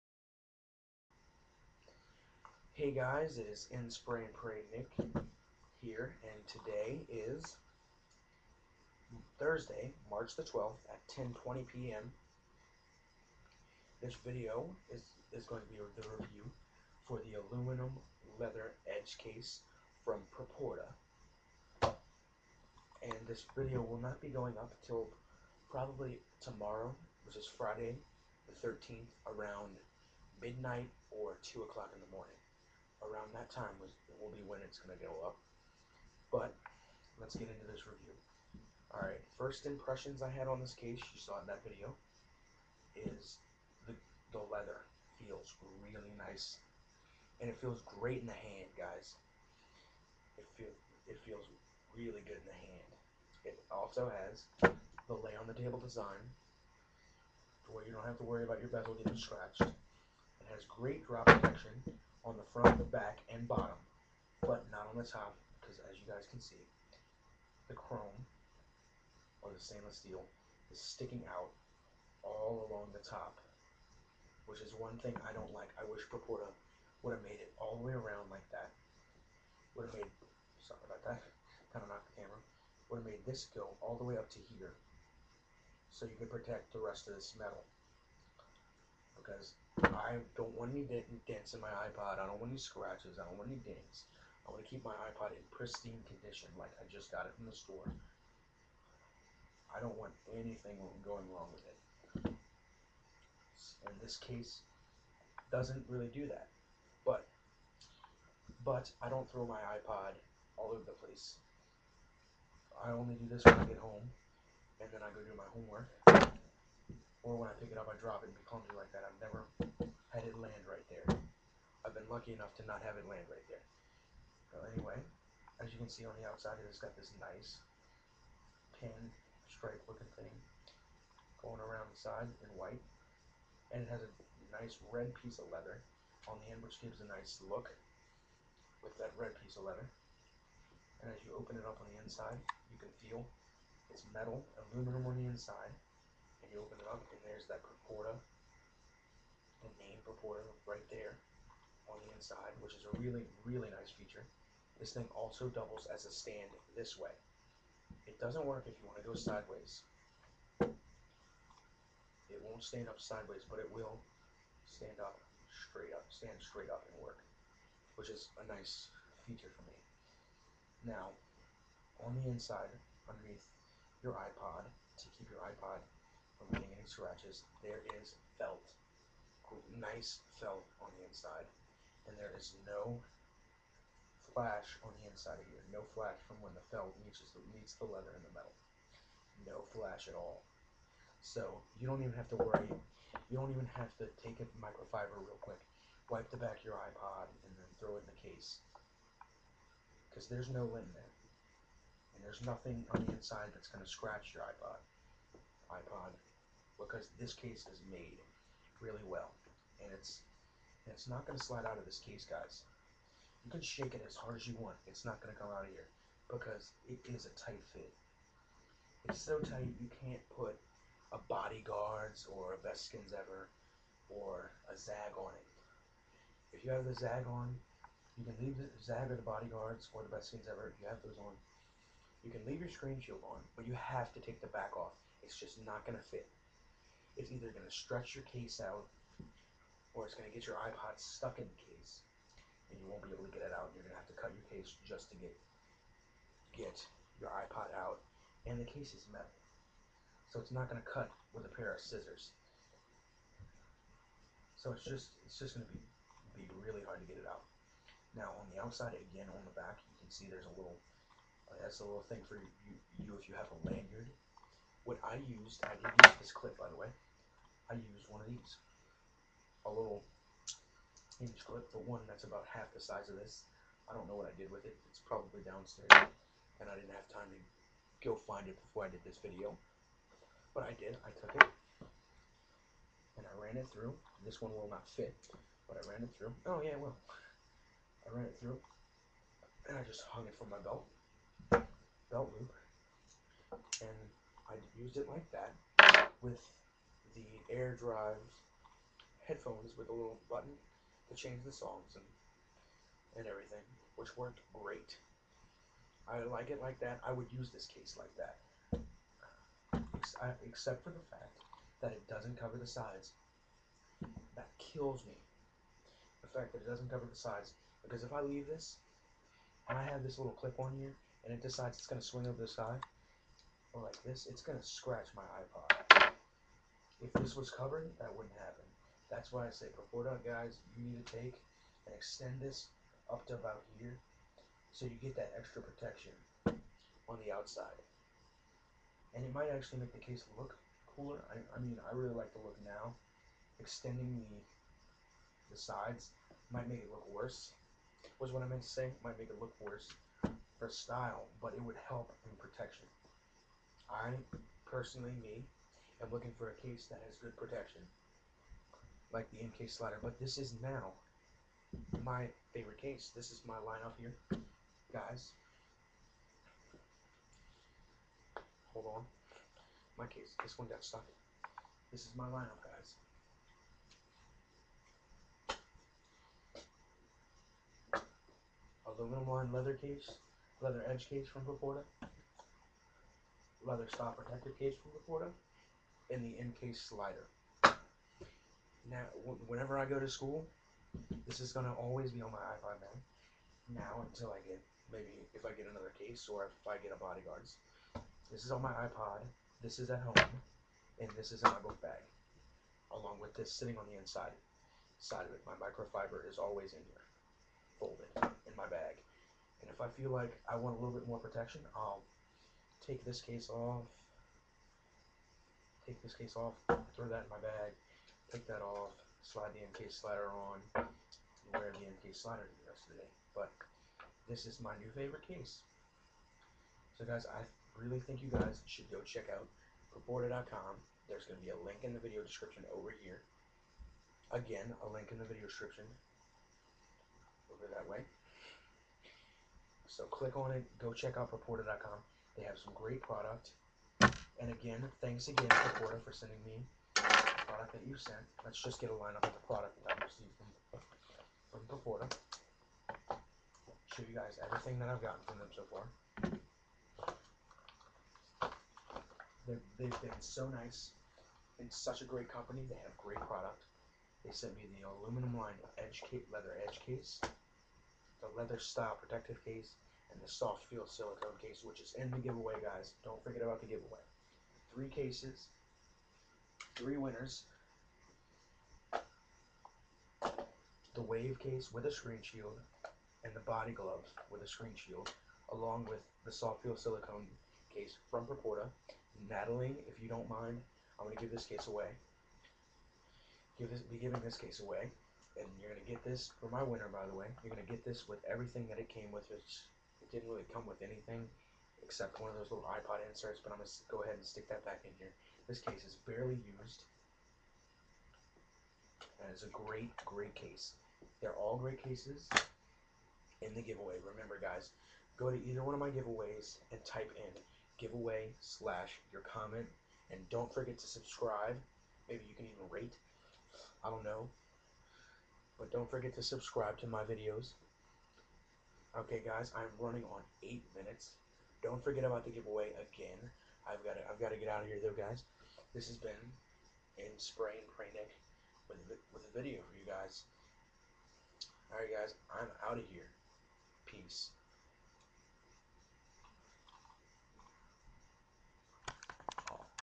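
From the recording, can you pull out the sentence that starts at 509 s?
And it's a great, great case.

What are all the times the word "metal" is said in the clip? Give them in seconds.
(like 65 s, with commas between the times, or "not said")
87 s, 144 s, 188 s, 249 s.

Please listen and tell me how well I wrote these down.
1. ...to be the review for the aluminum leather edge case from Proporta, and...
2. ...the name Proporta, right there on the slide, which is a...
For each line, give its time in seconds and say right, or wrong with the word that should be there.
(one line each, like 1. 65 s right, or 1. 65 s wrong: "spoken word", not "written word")
1. 15 s right
2. 149 s wrong: "inside", not "slide".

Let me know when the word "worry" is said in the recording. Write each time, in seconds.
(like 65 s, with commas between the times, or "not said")
58 s, 192 s.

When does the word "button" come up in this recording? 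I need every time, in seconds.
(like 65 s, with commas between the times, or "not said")
300 s.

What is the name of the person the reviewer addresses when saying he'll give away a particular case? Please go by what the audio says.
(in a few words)
Natalie.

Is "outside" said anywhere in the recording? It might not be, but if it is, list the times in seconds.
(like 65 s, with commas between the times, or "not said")
126 s, 258 s, 337 s.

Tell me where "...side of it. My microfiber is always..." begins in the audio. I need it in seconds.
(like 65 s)
404 s.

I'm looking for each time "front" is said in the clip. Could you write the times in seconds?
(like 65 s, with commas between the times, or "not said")
62 s.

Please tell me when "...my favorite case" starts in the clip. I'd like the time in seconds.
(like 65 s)
362 s.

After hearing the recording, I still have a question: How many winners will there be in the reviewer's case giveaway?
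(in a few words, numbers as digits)
3.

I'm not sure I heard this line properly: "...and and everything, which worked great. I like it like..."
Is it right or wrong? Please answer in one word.
right.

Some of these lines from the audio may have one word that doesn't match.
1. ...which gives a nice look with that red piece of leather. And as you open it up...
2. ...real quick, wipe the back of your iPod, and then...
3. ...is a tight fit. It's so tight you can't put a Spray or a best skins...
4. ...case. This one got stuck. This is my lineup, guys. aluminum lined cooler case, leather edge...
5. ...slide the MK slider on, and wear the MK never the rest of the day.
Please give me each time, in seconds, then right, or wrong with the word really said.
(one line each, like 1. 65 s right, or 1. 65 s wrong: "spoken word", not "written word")
1. 136 s right
2. 195 s right
3. 217 s wrong: "BodyGuardz", not "Spray"
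4. 370 s wrong: "leather", not "cooler"
5. 419 s wrong: "slider", not "never".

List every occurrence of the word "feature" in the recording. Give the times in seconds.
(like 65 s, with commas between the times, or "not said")
153 s, 169 s.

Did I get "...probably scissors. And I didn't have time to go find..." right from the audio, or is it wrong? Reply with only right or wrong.
wrong.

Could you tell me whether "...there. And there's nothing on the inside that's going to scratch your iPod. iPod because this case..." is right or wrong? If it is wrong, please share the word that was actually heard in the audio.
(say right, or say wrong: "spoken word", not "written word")
right.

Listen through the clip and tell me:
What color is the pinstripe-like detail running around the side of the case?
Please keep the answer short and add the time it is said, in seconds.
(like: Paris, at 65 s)
White, at 132 s.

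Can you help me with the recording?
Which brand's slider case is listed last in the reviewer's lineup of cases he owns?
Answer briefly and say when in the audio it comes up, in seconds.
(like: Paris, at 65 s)
Incase, at 386 s.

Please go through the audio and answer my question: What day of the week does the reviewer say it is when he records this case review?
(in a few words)
Thursday.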